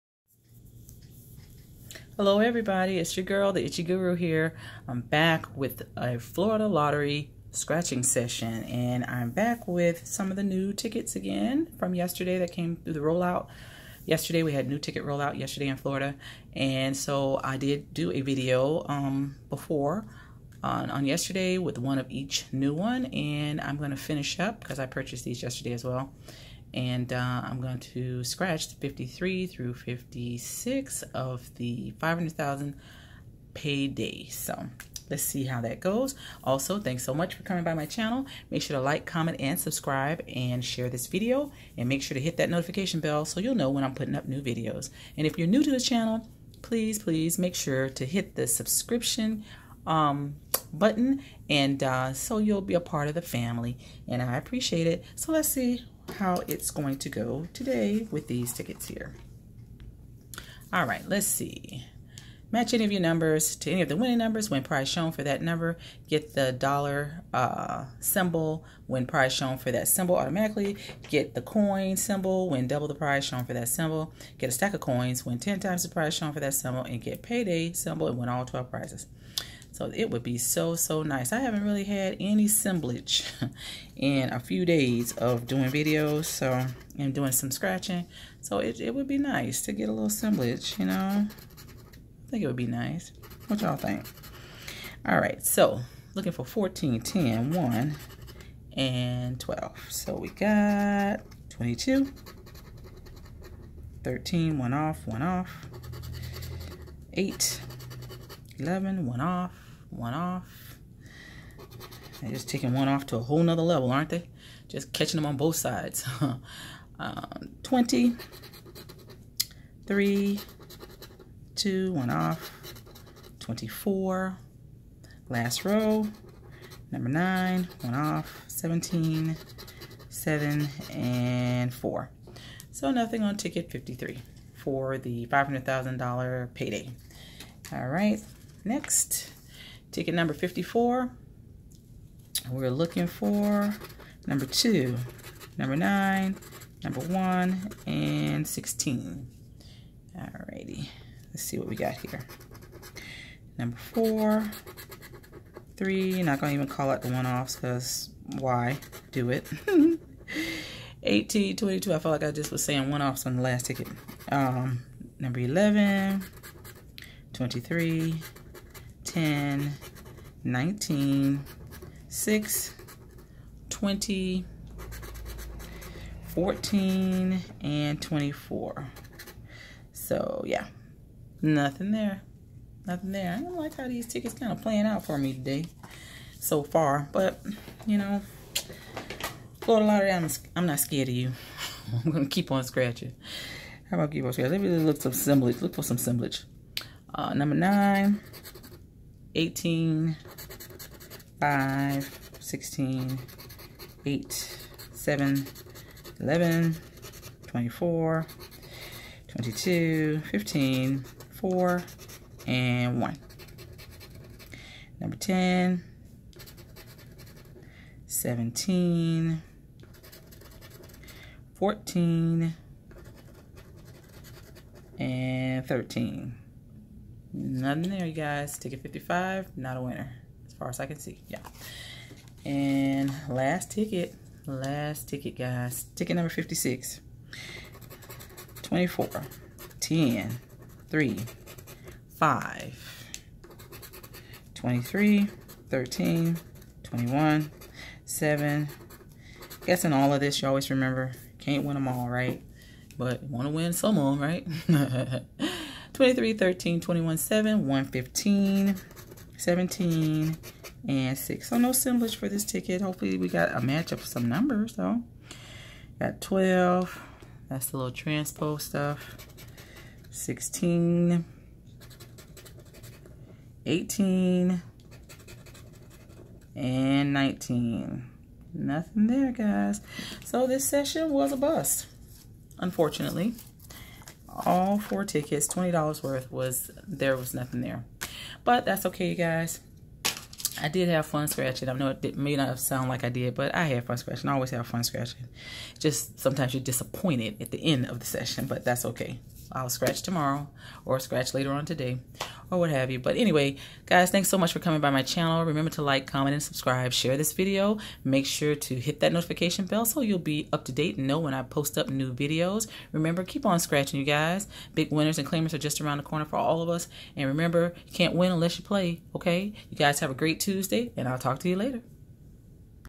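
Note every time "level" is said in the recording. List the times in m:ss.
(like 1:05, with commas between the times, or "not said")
1:53.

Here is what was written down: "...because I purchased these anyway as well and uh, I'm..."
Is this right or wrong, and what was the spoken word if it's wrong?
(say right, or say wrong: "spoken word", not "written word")
wrong: "yesterday", not "anyway".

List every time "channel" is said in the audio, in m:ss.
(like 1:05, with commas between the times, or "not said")
0:37, 0:45, 5:05.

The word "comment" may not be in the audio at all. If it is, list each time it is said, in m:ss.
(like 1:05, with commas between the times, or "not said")
0:39, 5:06.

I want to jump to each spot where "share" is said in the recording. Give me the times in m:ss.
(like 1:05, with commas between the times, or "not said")
0:40, 5:06.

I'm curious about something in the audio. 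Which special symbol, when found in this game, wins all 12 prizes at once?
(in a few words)
payday symbol.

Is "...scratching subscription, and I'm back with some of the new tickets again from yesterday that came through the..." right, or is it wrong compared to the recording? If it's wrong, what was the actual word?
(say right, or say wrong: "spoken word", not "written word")
wrong: "session", not "subscription".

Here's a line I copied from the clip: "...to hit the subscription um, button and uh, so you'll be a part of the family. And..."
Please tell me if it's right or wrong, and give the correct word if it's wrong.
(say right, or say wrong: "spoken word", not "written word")
right.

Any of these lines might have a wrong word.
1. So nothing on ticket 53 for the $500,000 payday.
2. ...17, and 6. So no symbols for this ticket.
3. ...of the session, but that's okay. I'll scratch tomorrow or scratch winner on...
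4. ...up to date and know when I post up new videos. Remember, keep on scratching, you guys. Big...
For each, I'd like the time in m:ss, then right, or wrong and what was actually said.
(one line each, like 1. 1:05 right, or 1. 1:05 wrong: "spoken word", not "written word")
1. 2:12 right
2. 4:19 right
3. 4:57 wrong: "later", not "winner"
4. 5:10 right.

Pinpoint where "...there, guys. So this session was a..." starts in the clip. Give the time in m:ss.
4:39.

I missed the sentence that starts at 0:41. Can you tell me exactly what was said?
And make sure to hit that notification bell so you'll know when I'm putting up new videos.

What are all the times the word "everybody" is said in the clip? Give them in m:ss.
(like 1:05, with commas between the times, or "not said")
0:02.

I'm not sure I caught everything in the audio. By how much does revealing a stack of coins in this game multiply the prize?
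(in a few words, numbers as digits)
10 times.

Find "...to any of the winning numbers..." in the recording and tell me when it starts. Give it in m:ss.
1:03.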